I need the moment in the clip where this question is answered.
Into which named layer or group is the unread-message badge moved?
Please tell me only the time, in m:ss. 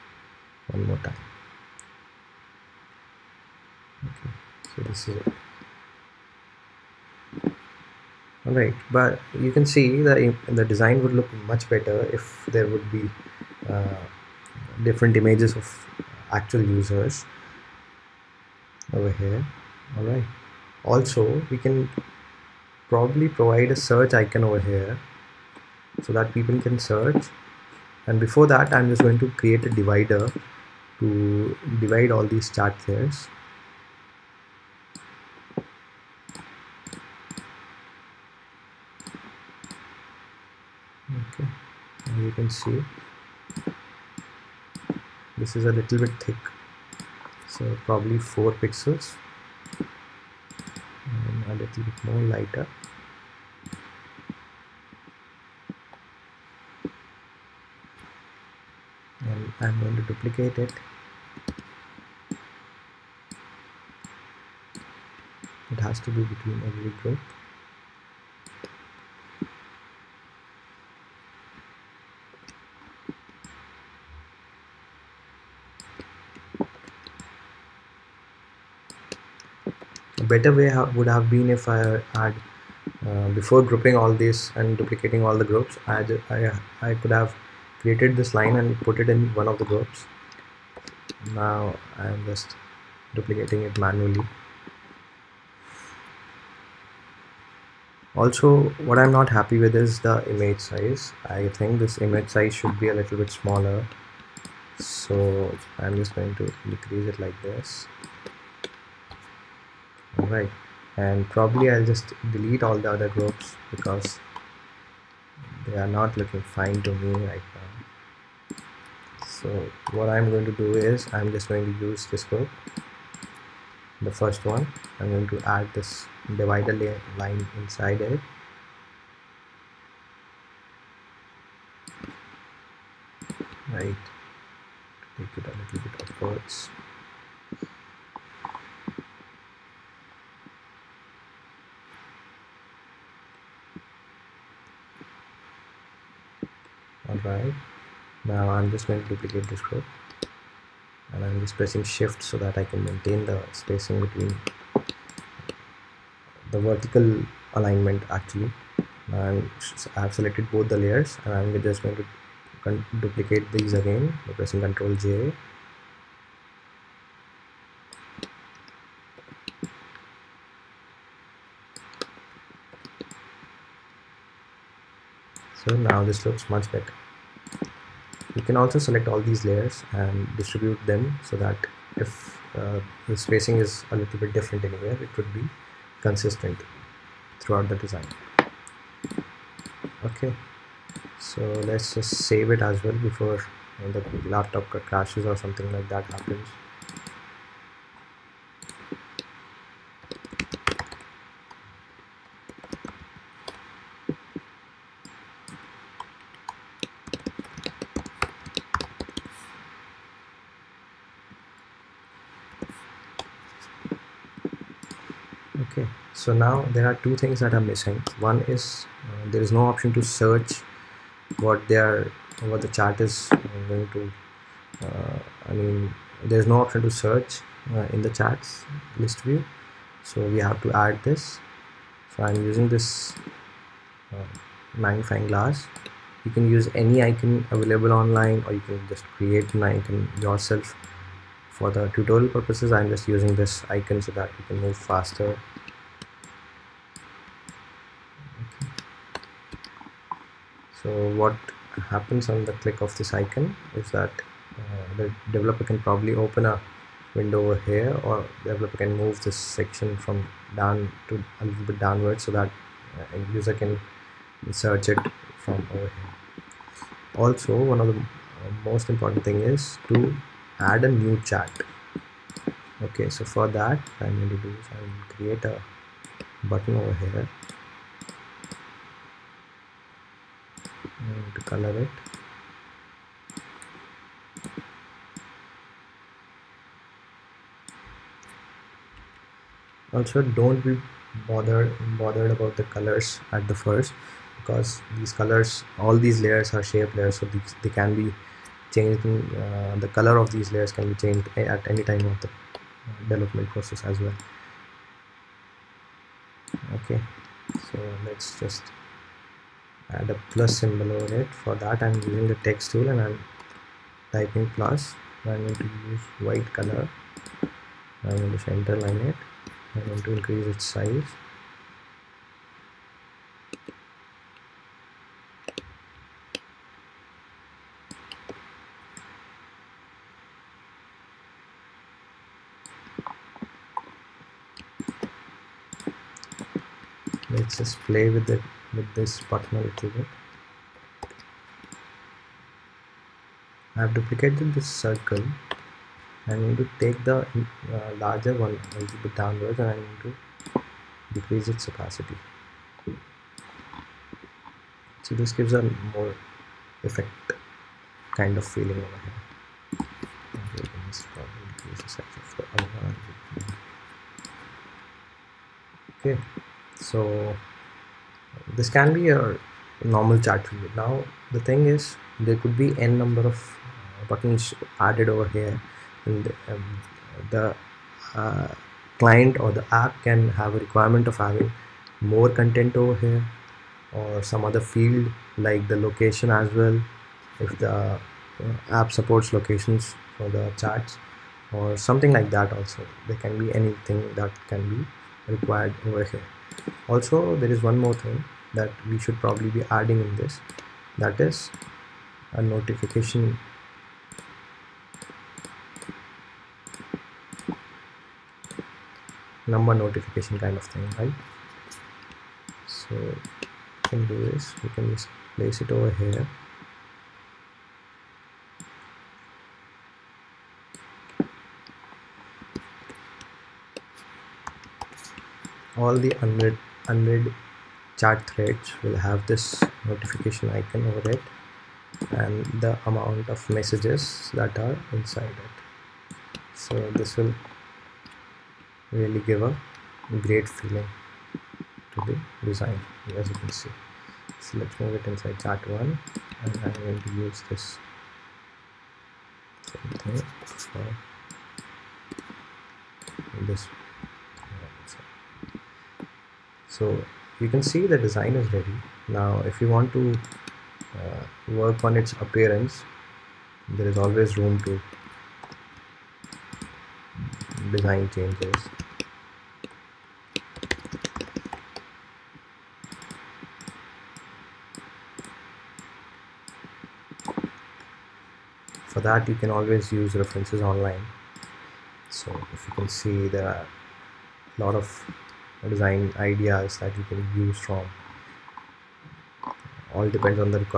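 7:25.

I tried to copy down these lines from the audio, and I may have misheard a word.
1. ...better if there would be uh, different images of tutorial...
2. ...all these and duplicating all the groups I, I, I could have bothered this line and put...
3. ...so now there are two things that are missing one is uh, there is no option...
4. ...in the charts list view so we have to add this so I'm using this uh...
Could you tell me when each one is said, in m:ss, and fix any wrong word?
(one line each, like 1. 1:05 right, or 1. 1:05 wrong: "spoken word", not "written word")
1. 0:11 wrong: "actual", not "tutorial"
2. 1:23 wrong: "created", not "bothered"
3. 3:36 right
4. 3:47 right.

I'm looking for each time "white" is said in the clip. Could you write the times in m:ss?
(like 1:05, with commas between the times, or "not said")
5:16.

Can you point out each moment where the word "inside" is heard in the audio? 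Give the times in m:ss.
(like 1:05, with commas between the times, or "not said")
2:07, 7:14, 7:25.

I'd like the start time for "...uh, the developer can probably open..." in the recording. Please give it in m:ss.
4:14.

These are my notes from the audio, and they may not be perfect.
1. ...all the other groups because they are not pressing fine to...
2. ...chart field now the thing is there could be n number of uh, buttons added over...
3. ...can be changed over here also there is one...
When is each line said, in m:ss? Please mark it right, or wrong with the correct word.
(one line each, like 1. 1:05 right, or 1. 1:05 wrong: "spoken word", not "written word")
1. 1:52 wrong: "looking", not "pressing"
2. 6:10 right
3. 6:34 wrong: "required", not "changed".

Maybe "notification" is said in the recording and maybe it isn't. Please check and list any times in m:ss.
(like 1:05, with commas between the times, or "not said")
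6:42, 6:49, 7:09.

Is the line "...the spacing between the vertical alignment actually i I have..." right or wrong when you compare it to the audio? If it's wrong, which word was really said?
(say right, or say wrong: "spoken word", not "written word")
right.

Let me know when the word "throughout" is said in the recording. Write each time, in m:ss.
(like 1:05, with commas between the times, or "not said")
3:07.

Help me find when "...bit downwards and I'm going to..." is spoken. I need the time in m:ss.
5:49.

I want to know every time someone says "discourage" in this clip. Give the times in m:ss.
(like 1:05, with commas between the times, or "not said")
not said.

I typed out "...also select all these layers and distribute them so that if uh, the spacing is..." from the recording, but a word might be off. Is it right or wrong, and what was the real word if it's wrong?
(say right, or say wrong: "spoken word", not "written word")
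right.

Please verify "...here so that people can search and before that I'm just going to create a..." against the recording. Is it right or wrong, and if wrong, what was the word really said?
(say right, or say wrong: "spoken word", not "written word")
right.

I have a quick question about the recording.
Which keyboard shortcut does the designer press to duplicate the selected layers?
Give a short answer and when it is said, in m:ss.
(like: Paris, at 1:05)
Ctrl J, at 2:44.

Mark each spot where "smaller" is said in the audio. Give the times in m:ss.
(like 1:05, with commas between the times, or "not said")
1:43.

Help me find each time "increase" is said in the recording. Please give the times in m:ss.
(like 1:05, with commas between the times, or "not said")
5:20.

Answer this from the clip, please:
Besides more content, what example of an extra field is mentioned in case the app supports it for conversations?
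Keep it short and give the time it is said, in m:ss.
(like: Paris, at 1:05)
location, at 6:25.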